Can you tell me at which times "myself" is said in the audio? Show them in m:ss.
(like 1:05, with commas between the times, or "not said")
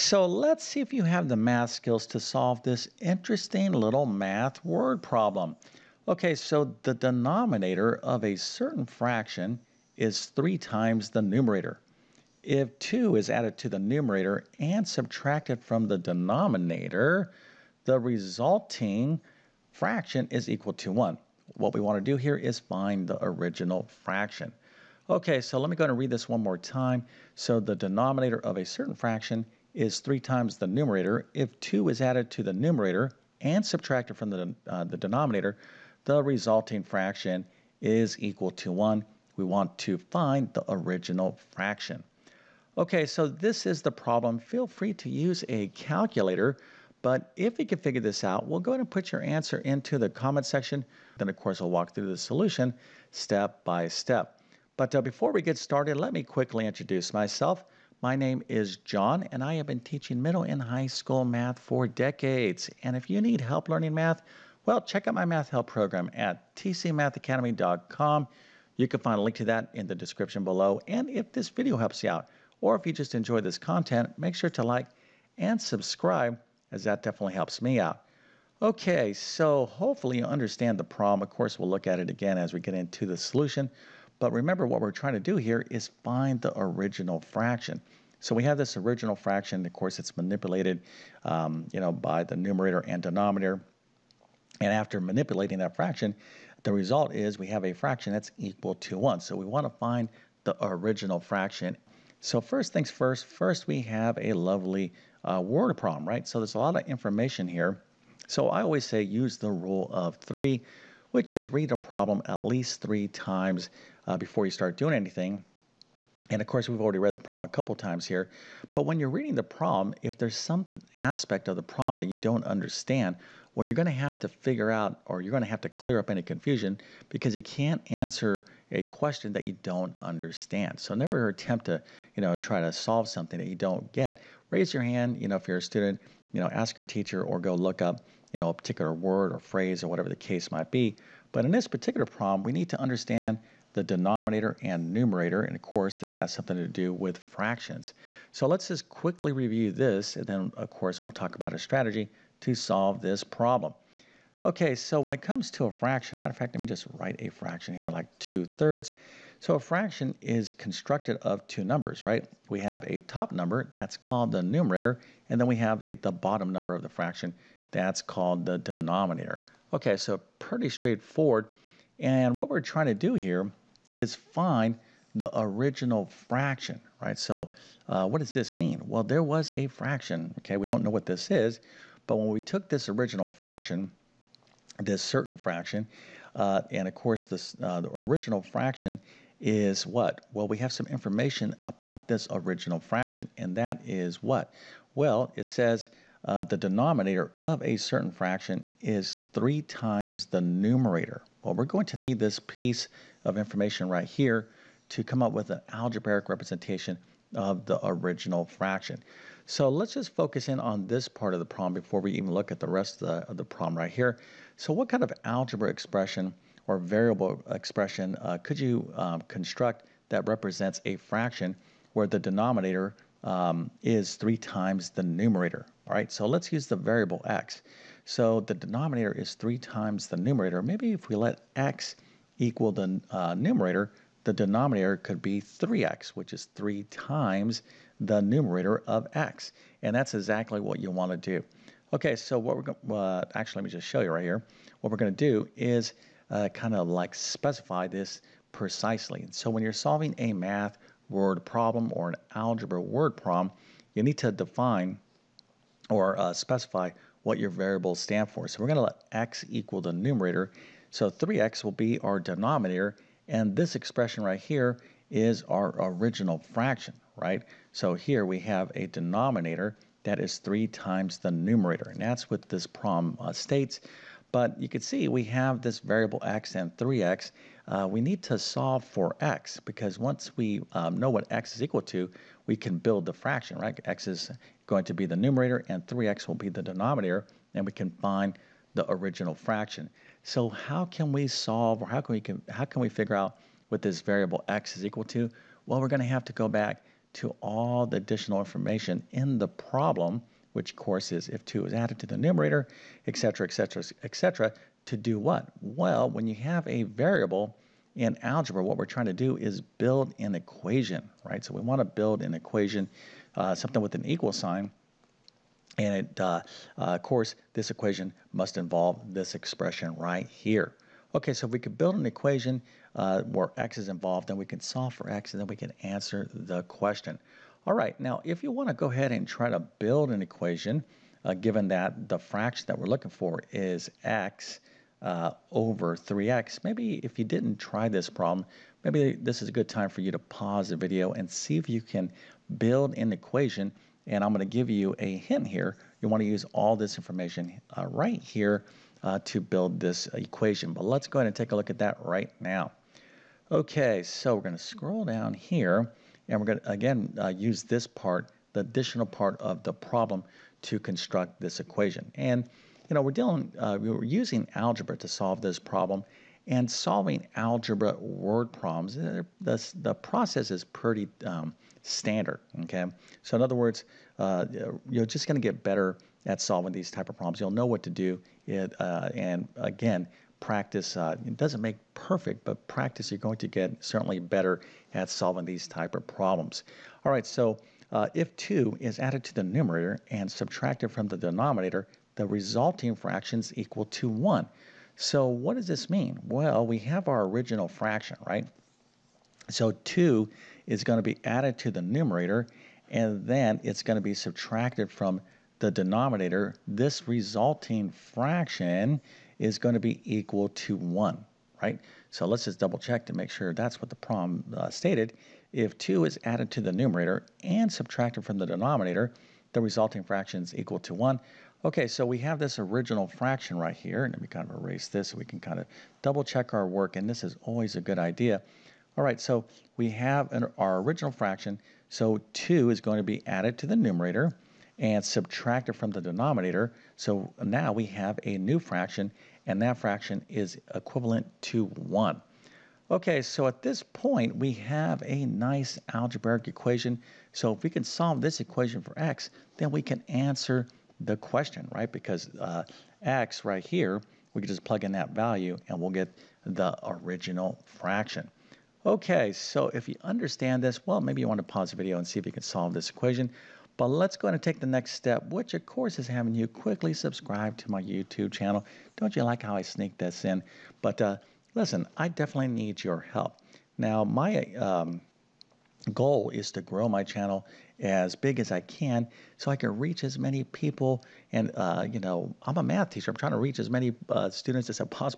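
0:57.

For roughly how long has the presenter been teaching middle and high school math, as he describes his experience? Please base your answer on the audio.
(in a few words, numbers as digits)
decades.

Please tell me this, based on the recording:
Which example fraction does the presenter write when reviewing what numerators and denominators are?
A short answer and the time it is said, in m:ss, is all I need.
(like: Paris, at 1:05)
2/3, at 2:38.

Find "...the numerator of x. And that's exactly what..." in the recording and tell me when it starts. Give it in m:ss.
3:57.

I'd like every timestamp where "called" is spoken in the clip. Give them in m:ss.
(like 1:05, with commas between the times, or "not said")
2:43, 2:48.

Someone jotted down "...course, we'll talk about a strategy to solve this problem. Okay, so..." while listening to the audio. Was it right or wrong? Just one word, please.
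right.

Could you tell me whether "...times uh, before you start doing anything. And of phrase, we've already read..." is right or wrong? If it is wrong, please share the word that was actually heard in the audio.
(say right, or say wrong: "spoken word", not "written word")
wrong: "course", not "phrase".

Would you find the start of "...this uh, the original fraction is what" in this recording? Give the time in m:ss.
3:07.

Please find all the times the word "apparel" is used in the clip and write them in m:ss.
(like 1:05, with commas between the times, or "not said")
not said.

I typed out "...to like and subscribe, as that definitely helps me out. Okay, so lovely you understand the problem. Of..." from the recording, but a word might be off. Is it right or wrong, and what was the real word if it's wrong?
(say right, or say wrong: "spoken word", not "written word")
wrong: "hopefully", not "lovely".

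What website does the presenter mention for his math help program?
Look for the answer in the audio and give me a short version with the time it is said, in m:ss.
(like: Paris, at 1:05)
tcmathacademy.com, at 1:06.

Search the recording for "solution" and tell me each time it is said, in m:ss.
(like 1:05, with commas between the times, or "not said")
0:52, 1:23.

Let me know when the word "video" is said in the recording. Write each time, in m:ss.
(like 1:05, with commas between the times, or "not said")
1:11, 5:40, 7:41.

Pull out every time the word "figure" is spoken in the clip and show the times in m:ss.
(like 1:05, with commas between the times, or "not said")
0:47, 2:04, 4:52.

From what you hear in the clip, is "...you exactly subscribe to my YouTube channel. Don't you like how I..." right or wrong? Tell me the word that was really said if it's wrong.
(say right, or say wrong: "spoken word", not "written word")
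wrong: "quickly", not "exactly".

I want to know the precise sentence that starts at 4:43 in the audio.
x is going to be the numerator and 3x will be the denominator, and we can find the original fraction.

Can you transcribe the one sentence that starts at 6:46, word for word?
This resulting fraction is going to be equal to 1, right?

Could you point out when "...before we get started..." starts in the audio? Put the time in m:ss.
0:55.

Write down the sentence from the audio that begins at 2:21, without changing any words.
But in this particular problem, we need to understand the denominator and numerator.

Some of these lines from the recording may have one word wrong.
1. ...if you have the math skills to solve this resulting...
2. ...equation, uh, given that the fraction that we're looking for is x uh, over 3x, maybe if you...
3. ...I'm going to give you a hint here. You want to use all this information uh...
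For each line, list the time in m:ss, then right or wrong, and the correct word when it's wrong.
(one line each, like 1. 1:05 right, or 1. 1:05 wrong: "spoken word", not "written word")
1. 0:00 wrong: "interesting", not "resulting"
2. 5:30 right
3. 5:44 right.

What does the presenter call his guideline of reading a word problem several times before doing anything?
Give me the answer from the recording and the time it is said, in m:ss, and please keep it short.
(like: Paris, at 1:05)
rule of 3, at 1:49.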